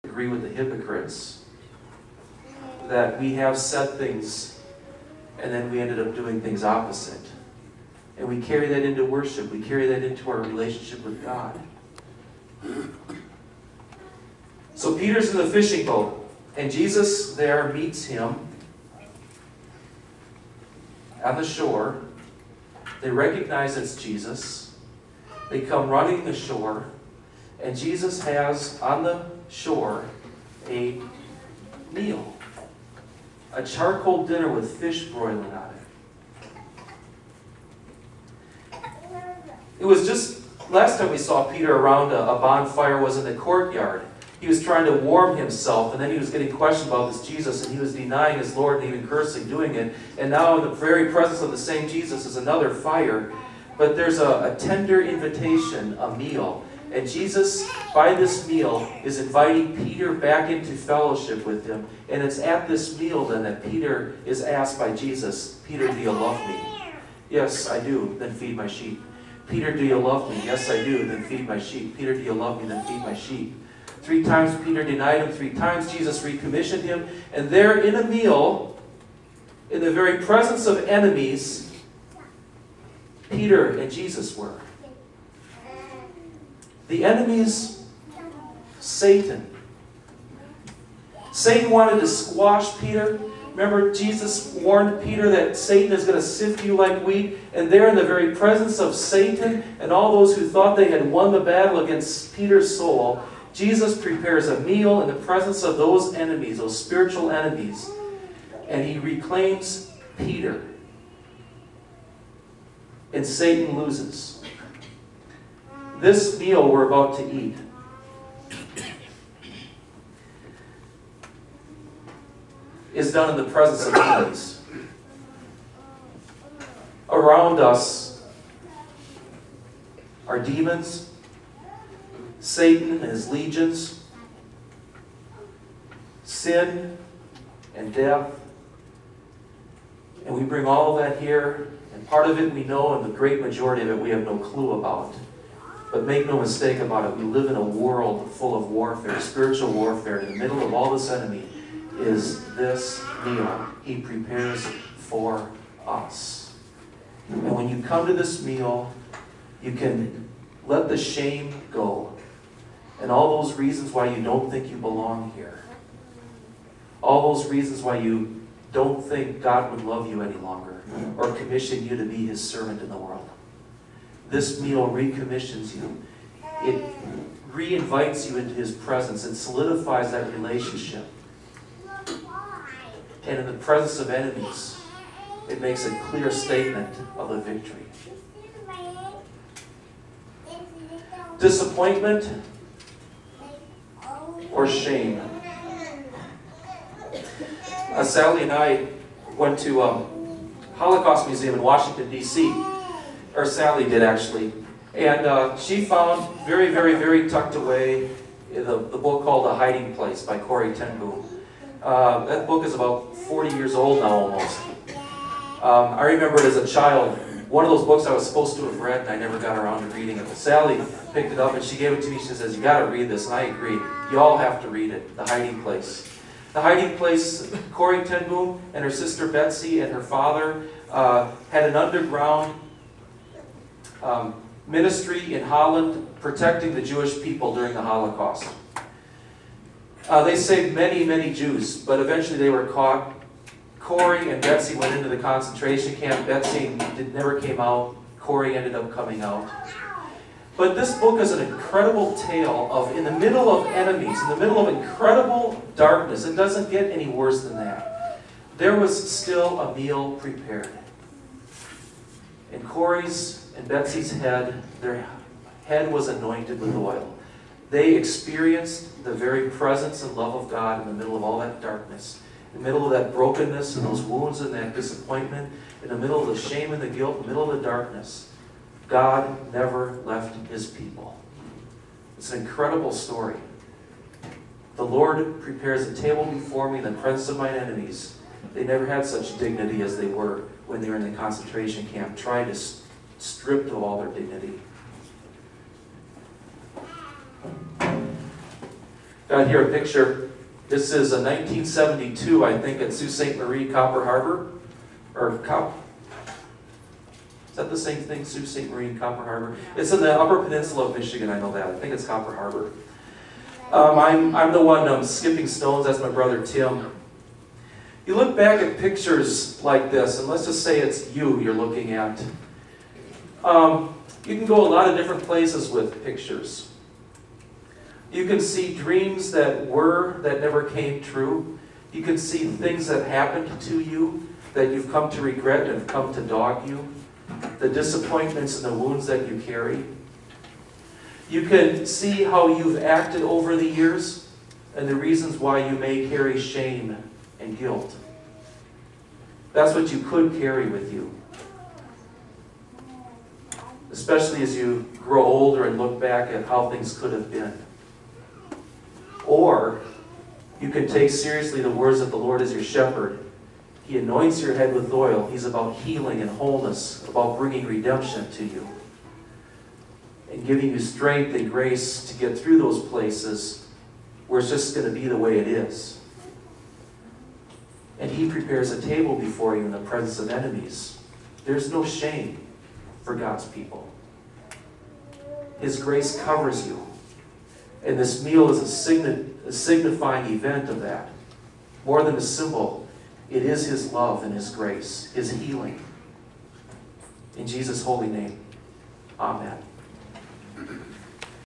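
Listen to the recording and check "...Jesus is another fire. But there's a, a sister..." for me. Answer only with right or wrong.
wrong.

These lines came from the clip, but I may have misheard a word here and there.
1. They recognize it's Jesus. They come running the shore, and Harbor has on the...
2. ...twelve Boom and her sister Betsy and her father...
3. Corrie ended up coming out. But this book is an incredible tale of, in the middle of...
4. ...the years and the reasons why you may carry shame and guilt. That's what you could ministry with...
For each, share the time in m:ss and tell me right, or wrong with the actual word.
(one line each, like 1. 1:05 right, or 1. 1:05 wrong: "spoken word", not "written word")
1. 0:23 wrong: "Jesus", not "Harbor"
2. 3:48 wrong: "ten", not "twelve"
3. 4:08 right
4. 5:43 wrong: "carry", not "ministry".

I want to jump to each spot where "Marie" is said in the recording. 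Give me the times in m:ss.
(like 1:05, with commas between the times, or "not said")
5:03, 5:08.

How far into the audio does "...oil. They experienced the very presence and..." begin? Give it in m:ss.
4:26.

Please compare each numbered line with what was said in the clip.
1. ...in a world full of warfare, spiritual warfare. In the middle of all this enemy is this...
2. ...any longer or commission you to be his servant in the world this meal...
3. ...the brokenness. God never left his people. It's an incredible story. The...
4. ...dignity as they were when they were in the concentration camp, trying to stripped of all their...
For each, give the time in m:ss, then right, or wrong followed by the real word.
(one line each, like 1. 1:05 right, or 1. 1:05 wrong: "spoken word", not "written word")
1. 2:27 right
2. 2:50 right
3. 4:37 wrong: "darkness", not "brokenness"
4. 4:49 right.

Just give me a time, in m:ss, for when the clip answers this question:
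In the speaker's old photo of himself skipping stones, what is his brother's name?
5:16.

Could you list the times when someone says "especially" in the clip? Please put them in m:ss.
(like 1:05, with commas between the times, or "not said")
5:53.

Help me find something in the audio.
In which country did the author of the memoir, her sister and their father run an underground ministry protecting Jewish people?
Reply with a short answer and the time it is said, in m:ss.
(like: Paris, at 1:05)
Holland, at 3:55.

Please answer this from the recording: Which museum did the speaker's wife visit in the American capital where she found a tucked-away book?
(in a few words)
Holocaust Museum.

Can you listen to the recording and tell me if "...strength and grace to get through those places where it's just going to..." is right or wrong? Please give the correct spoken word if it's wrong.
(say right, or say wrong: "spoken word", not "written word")
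right.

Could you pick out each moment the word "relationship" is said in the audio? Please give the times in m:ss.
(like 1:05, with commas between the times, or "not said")
0:10, 3:00.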